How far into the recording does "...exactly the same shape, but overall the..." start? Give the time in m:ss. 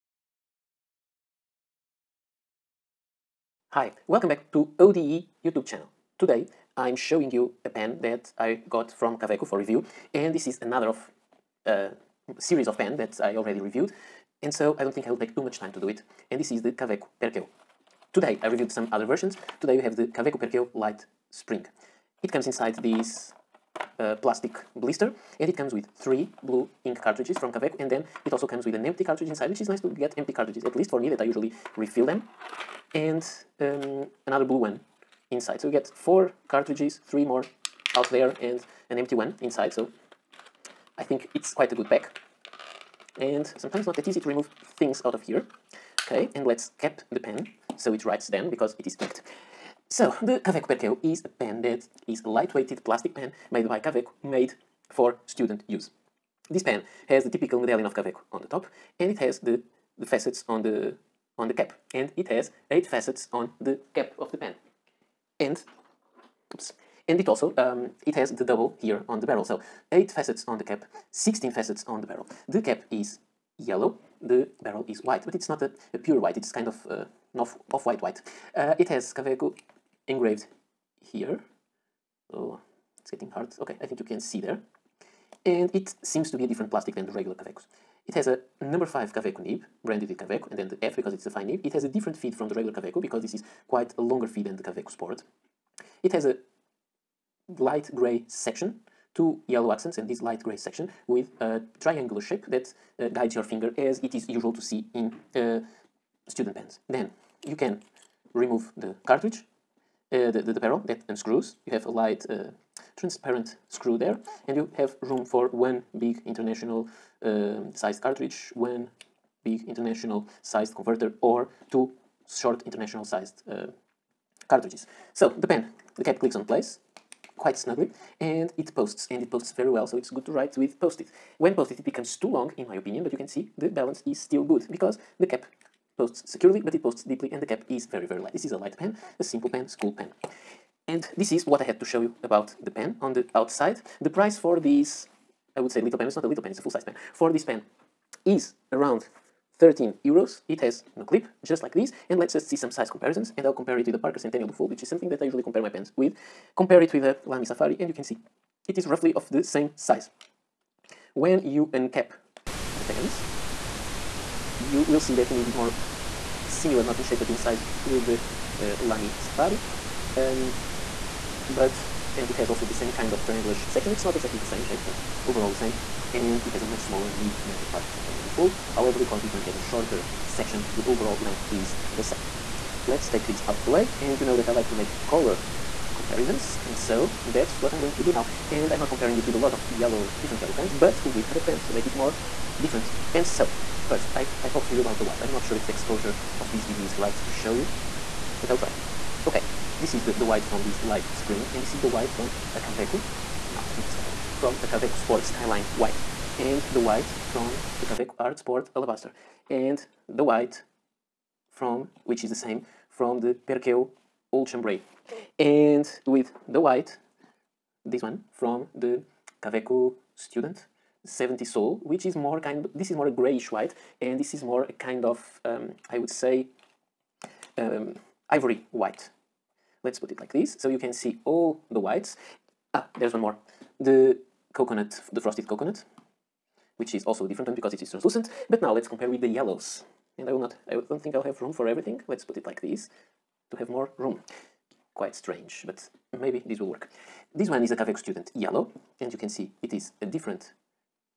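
2:54.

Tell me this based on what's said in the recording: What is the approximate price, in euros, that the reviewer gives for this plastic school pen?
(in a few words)
13 euros.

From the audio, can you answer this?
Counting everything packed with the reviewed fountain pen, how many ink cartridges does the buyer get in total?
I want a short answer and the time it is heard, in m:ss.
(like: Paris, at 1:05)
4, at 0:35.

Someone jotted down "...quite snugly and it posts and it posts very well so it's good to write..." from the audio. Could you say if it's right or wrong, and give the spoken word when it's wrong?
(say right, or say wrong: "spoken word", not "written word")
right.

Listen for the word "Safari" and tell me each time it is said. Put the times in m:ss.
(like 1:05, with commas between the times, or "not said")
2:37, 2:49.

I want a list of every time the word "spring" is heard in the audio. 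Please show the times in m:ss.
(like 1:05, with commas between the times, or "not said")
0:21, 3:21.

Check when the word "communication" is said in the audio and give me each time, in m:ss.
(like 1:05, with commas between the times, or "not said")
not said.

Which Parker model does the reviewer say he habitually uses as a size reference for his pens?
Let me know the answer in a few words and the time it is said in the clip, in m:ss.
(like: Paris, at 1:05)
Parker Centennial Duofold, at 2:33.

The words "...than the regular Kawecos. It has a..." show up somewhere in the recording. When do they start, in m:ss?
1:26.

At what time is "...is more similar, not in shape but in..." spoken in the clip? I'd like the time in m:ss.
2:45.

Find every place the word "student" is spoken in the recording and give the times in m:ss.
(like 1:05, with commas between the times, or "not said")
0:55, 1:46, 3:40, 4:07.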